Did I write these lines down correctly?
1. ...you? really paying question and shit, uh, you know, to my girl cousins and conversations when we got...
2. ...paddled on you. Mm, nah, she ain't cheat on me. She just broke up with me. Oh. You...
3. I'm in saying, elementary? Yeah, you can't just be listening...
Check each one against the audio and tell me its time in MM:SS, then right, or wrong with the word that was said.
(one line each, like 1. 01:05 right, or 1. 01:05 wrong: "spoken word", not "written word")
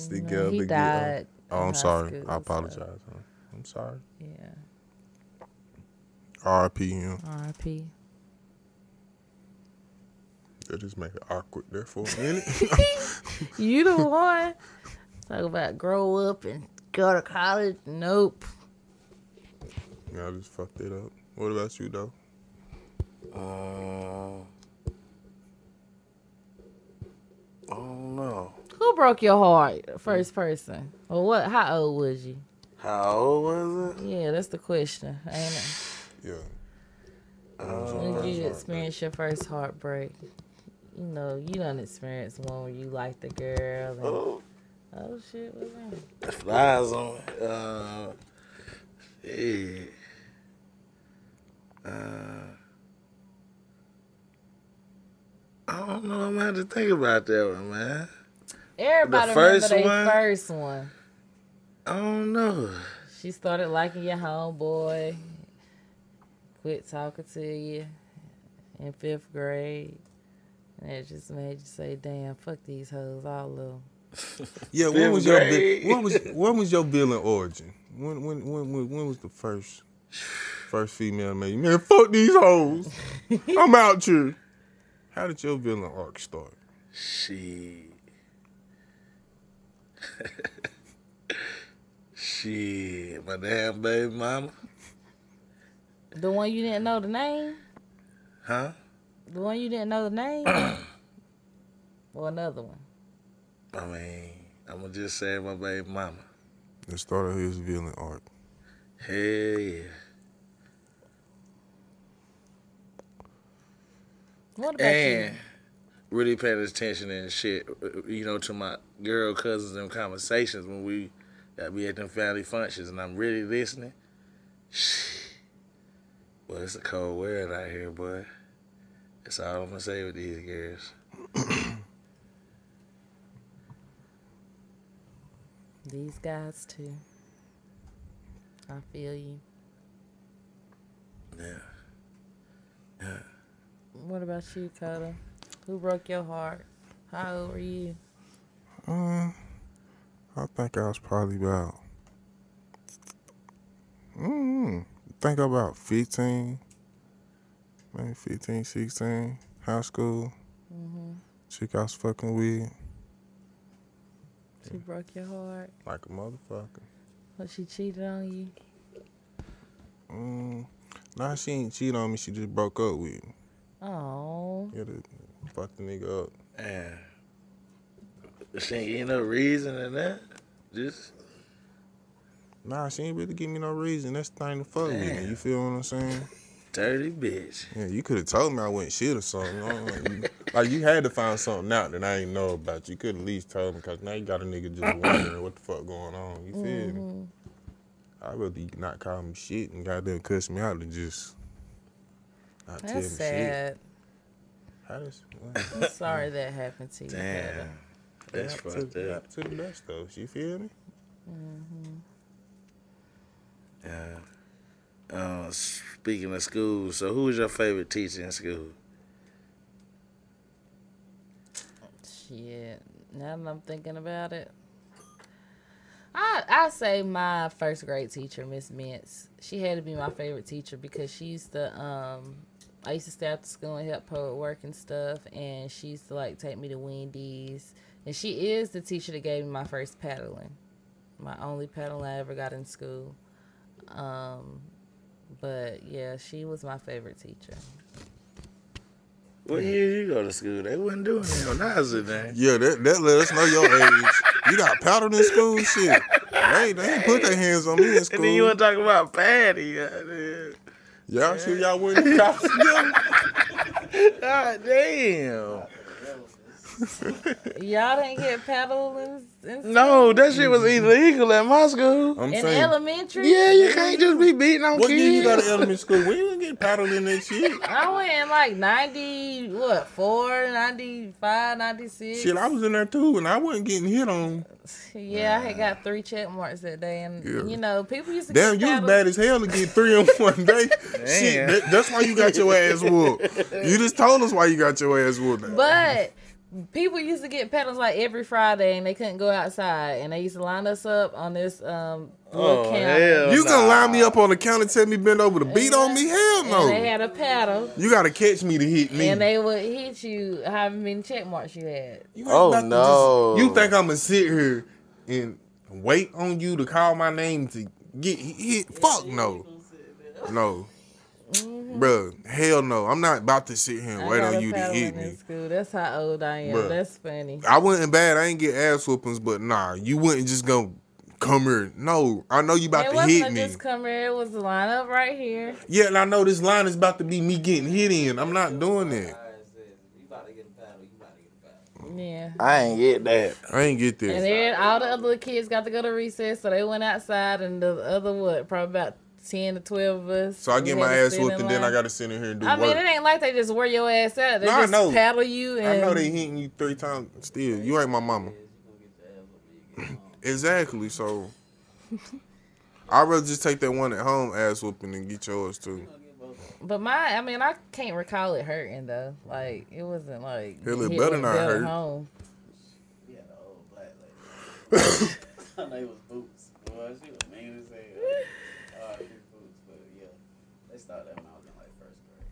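1. 01:55 wrong: "attention", not "question"
2. 02:47 wrong: "cheated", not "paddled"
3. 04:32 wrong: "beating", not "listening".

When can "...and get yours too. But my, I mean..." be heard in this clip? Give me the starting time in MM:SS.
06:04.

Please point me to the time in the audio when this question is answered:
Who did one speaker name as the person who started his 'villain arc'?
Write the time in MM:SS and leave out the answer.
01:33.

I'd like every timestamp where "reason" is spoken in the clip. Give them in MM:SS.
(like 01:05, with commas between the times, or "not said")
02:59, 03:03.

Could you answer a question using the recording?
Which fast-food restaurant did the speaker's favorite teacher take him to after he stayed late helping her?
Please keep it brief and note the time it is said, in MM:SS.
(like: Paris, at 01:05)
Wendy's, at 03:56.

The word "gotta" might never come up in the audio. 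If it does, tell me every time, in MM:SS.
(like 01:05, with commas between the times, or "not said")
02:54, 05:07, 05:51.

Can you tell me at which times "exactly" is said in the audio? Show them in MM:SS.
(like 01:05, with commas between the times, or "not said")
06:00.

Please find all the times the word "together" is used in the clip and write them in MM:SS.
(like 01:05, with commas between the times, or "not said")
00:00.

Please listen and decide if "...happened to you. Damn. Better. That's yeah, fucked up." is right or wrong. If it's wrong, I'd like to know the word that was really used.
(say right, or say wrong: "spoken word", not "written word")
right.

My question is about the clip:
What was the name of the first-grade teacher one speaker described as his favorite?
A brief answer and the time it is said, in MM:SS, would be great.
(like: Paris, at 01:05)
Miss Mintz, at 03:48.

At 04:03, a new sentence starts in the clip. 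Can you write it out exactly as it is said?
Um, but yeah, she was my favorite teacher.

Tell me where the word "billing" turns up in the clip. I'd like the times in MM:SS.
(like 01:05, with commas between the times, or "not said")
01:16.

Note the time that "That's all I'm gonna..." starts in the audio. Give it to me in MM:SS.
02:09.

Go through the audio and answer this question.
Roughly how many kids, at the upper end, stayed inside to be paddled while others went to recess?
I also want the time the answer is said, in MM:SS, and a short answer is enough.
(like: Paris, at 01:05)
12, at 05:49.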